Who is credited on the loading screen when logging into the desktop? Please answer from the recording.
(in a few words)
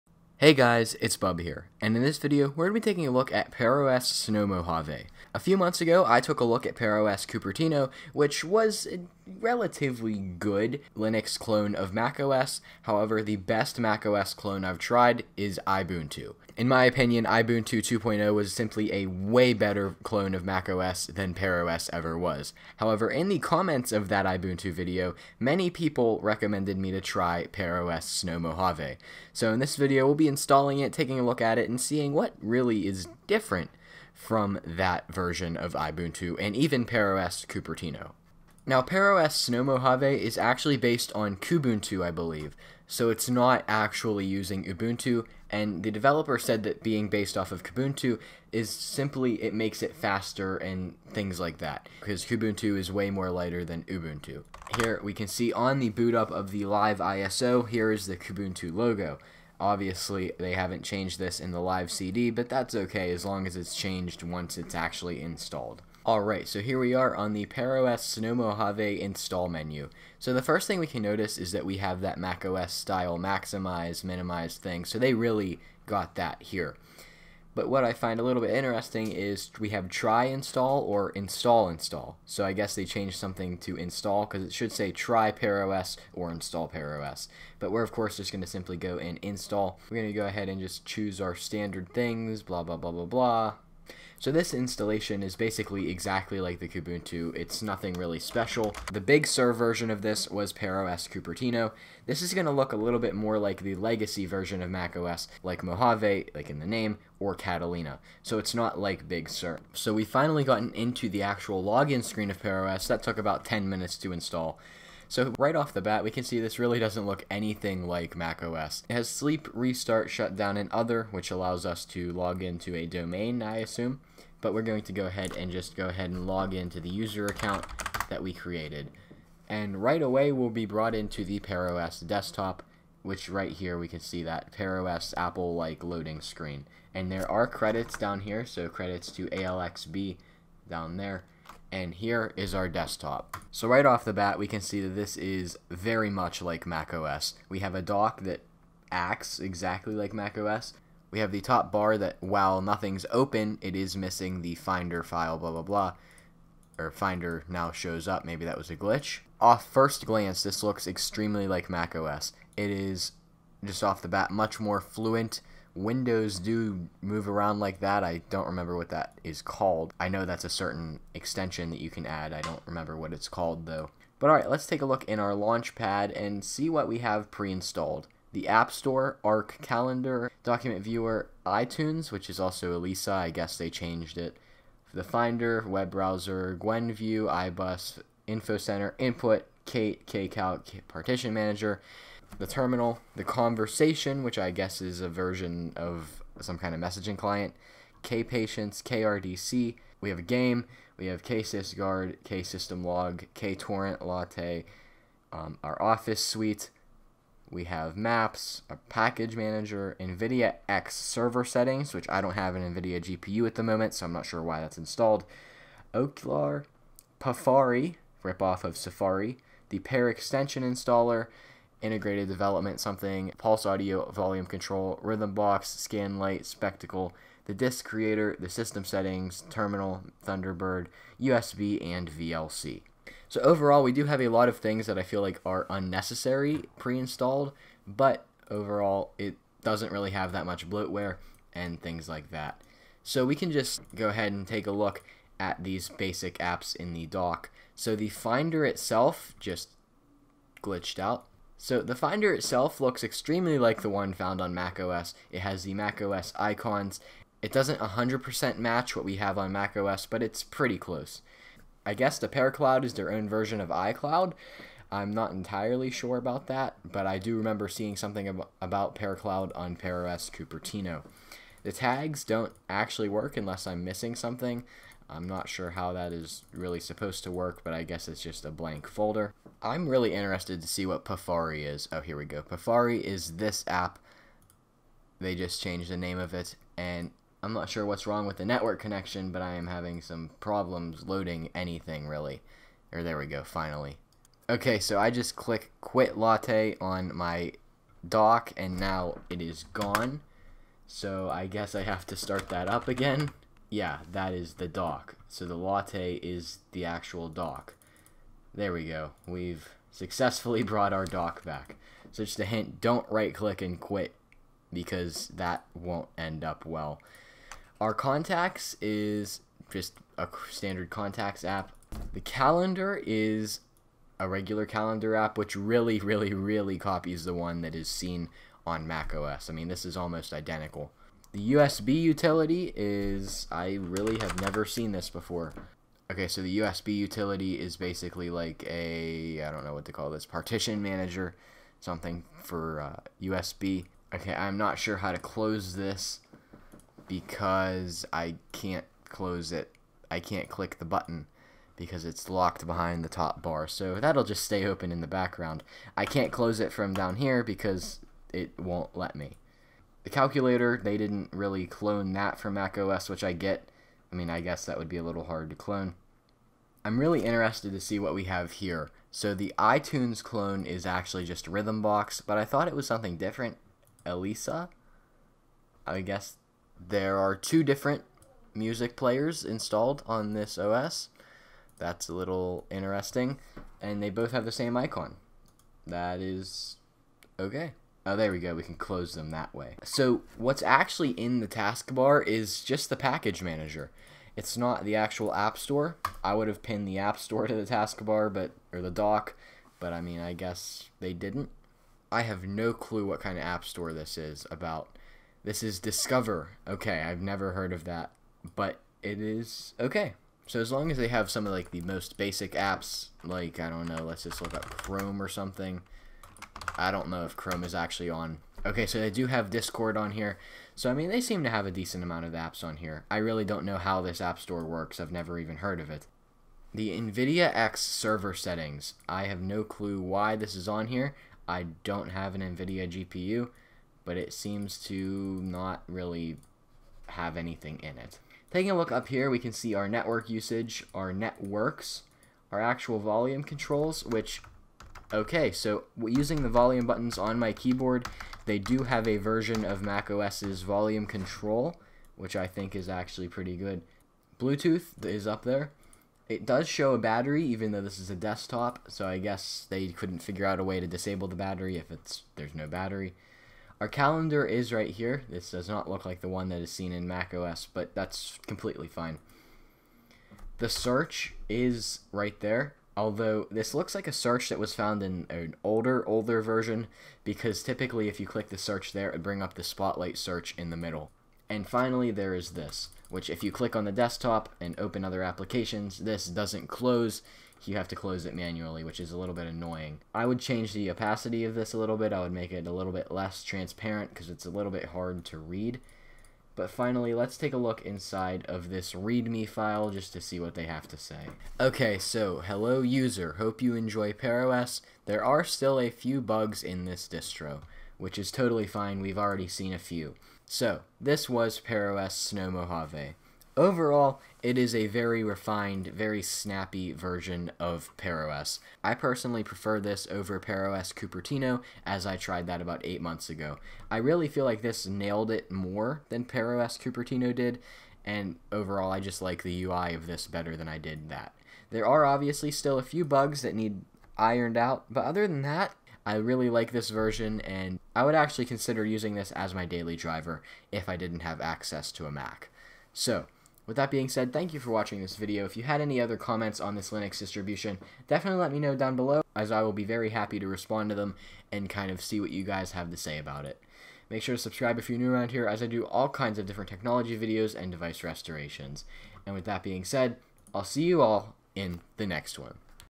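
ALXB.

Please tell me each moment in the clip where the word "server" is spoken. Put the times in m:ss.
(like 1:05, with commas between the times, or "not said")
3:30, 7:07.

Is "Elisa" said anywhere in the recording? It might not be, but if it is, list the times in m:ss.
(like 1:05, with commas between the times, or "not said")
3:02, 6:14.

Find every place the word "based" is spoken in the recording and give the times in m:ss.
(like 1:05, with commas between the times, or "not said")
0:40, 0:47.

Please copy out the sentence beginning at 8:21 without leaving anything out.
Okay, so hello user, hope you enjoy pearOS.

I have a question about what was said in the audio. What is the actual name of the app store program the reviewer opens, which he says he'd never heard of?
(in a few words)
Discover.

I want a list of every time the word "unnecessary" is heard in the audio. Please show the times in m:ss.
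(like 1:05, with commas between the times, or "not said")
3:55.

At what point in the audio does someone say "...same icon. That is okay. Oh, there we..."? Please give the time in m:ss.
6:24.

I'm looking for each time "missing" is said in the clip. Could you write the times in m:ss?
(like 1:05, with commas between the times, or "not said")
2:33, 4:33.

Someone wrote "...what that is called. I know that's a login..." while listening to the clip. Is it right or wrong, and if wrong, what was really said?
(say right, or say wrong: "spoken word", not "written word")
wrong: "certain", not "login".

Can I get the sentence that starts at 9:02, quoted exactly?
So, with that being said, thank you for watching this video.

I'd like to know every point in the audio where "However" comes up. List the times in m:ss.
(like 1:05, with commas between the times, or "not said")
0:12, 0:22.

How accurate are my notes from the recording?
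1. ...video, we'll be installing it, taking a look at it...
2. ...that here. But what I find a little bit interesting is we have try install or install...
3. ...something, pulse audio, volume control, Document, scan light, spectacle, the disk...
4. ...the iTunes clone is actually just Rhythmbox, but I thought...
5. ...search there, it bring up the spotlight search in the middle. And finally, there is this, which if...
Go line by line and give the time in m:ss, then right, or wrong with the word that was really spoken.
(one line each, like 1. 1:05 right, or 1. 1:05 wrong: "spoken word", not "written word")
1. 0:29 right
2. 1:16 right
3. 3:42 wrong: "Rhythmbox", not "Document"
4. 6:09 right
5. 7:58 right.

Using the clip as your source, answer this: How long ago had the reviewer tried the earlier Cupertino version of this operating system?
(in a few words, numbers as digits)
8 months.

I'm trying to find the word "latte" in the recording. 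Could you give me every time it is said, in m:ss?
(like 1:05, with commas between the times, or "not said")
3:24, 4:56, 5:05.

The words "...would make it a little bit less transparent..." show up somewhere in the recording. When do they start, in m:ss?
8:12.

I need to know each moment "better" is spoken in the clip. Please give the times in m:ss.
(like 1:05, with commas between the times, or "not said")
0:19, 8:50.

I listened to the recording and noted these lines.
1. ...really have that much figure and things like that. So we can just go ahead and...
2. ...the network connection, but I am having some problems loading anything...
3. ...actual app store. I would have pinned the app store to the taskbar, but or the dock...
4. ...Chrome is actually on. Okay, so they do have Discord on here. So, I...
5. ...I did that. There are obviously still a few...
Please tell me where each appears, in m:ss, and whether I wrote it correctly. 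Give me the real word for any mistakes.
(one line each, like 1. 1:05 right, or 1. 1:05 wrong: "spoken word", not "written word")
1. 3:59 wrong: "bloatware", not "figure"
2. 4:48 right
3. 6:34 right
4. 6:57 right
5. 8:50 right.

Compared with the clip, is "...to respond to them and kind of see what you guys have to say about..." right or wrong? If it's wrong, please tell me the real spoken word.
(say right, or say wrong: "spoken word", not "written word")
right.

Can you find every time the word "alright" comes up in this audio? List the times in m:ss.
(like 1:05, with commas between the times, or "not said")
1:06, 2:54.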